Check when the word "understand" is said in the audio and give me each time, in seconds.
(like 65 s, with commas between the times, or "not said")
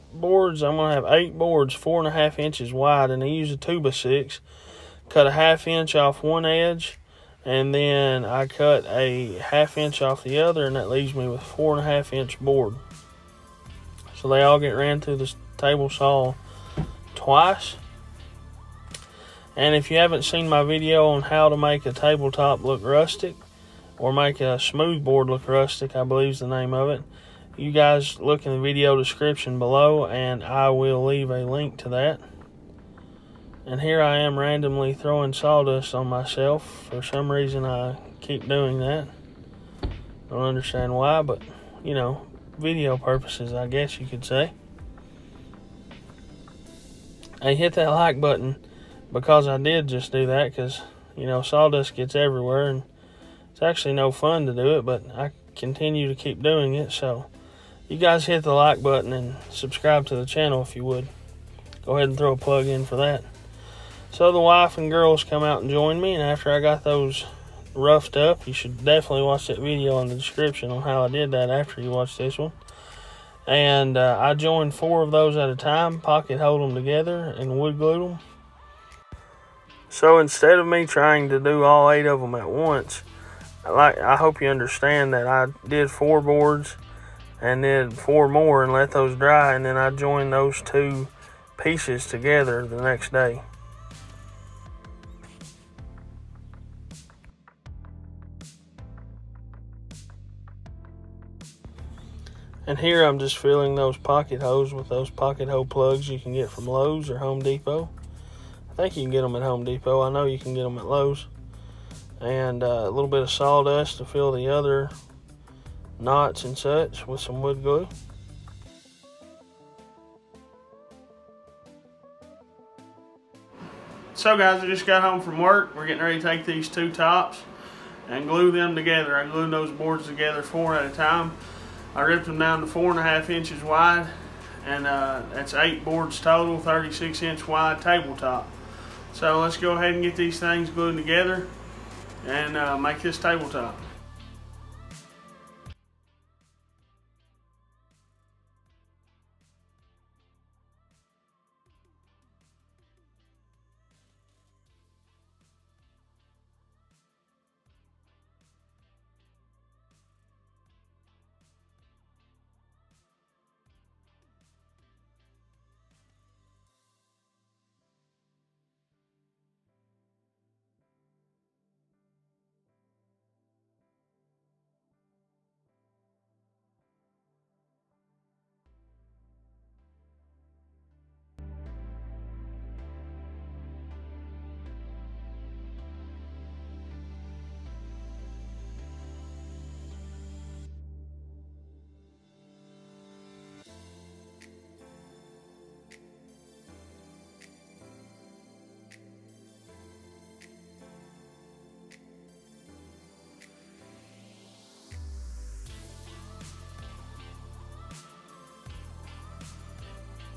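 40 s, 84 s.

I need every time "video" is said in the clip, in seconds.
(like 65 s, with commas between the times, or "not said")
20 s, 28 s, 42 s, 69 s.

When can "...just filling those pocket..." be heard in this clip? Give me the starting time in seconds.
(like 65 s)
103 s.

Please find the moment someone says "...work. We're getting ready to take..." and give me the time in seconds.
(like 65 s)
125 s.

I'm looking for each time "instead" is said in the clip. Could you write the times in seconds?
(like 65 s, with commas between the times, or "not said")
80 s.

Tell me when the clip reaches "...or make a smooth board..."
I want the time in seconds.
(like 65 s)
23 s.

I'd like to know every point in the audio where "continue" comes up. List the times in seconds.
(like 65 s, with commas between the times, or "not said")
55 s.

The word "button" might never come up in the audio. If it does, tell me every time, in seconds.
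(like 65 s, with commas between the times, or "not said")
48 s, 58 s.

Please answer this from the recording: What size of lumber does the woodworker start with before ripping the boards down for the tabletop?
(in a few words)
2x6.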